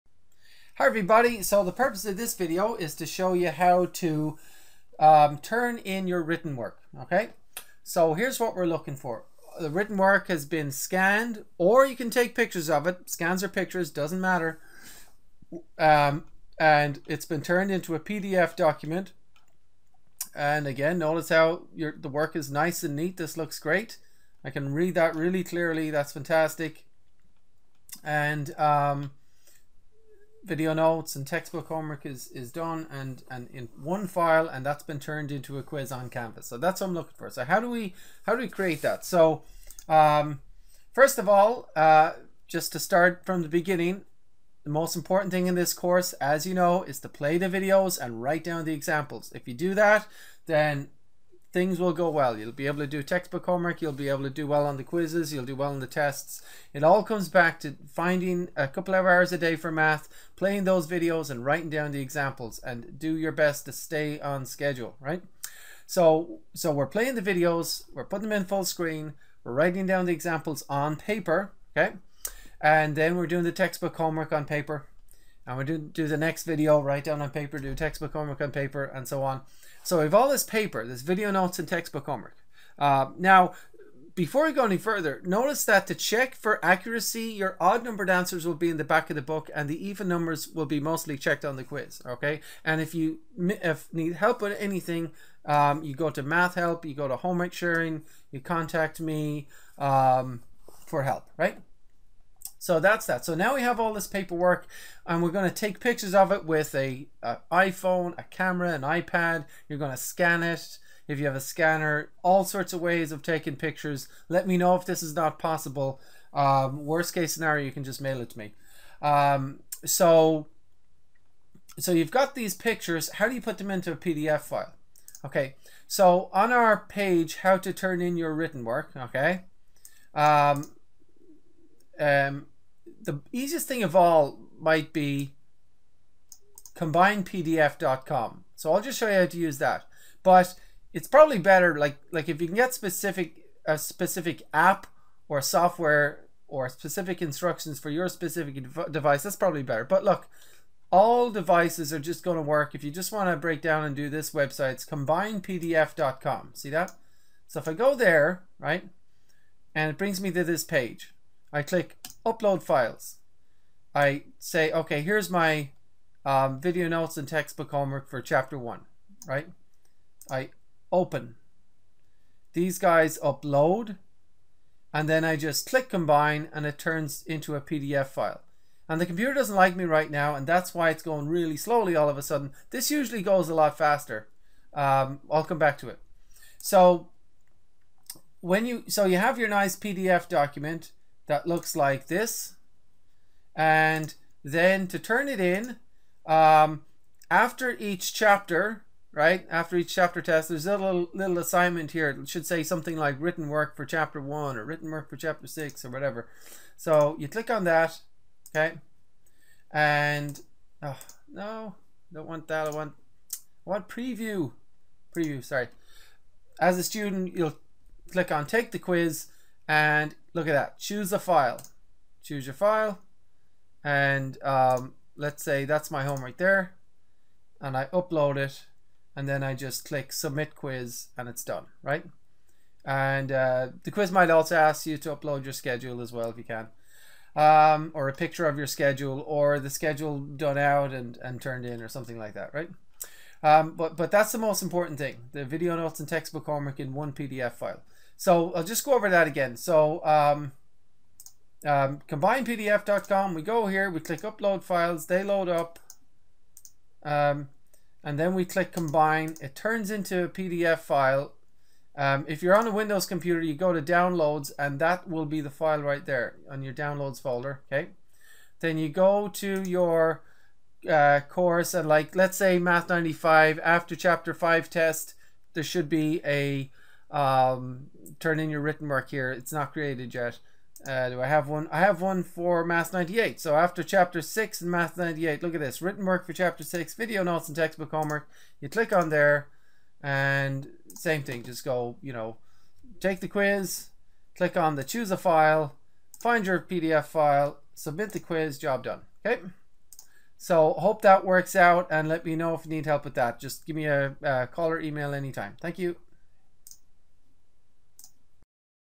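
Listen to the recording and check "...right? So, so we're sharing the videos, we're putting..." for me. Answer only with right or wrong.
wrong.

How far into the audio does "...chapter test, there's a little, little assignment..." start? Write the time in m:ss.
3:19.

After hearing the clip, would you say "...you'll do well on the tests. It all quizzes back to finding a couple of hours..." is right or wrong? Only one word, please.
wrong.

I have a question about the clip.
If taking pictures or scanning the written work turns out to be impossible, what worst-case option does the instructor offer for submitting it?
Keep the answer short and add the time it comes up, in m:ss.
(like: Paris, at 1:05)
mail it, at 1:57.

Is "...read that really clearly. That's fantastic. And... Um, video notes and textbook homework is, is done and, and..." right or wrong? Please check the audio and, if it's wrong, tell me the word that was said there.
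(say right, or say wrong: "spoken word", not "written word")
right.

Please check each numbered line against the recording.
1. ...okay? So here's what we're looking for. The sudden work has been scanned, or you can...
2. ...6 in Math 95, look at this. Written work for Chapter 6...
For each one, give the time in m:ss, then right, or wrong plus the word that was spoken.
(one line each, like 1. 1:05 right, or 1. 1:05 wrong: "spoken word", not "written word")
1. 0:07 wrong: "written", not "sudden"
2. 4:44 wrong: "98", not "95".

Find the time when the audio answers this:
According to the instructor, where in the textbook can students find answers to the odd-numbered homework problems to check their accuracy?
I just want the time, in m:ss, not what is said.
1:28.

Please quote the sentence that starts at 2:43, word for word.
I say, okay, here's my um, video notes and textbook homework for chapter one, right?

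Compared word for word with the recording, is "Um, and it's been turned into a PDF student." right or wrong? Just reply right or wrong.
wrong.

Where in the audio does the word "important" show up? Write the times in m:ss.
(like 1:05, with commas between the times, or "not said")
0:44, 4:04.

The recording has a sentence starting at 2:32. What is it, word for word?
If you just want to break down and do this website, it's combinepdf.com.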